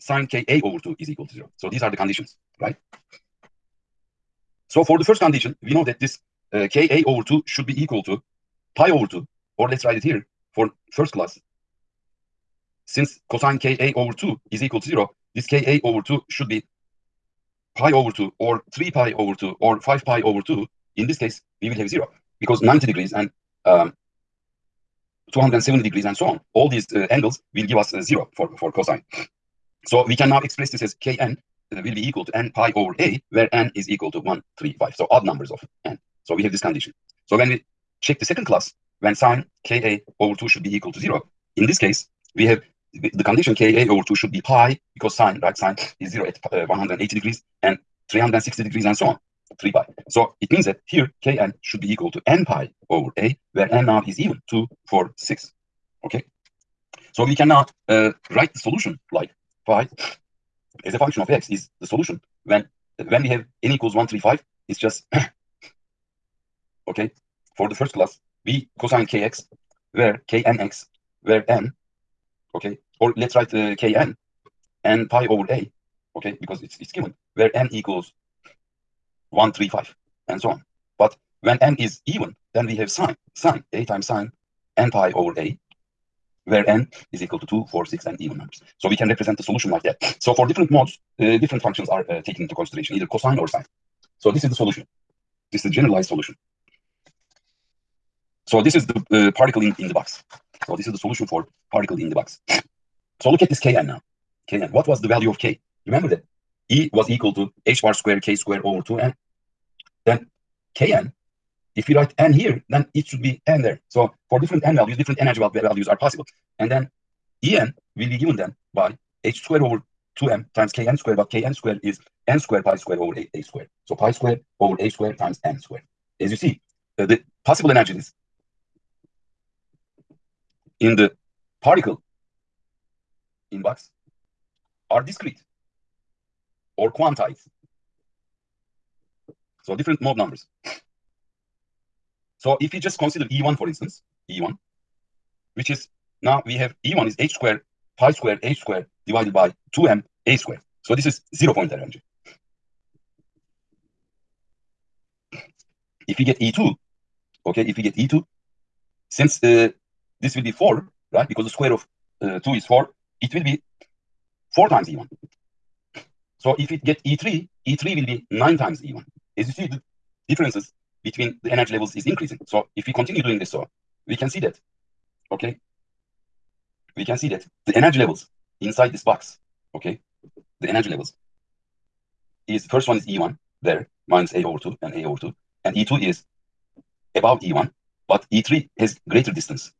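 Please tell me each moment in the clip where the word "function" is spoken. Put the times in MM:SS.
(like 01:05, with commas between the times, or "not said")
01:00, 01:31.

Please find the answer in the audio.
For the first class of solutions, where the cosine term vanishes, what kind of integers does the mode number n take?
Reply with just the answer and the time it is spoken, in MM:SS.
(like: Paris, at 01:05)
odd numbers, at 00:35.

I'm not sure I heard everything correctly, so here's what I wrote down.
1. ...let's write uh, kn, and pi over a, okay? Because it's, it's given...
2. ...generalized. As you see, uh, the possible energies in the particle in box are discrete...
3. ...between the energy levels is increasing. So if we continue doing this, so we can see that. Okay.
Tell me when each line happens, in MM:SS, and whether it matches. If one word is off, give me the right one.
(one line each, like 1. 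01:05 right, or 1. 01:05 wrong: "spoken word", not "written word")
1. 01:13 right
2. 02:05 wrong: "squared", not "generalized"
3. 02:51 right.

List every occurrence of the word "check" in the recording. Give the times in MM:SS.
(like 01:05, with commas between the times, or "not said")
00:38.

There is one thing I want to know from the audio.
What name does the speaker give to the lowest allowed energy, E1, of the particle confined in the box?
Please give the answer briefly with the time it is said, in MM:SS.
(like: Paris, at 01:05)
zero point energy, at 02:31.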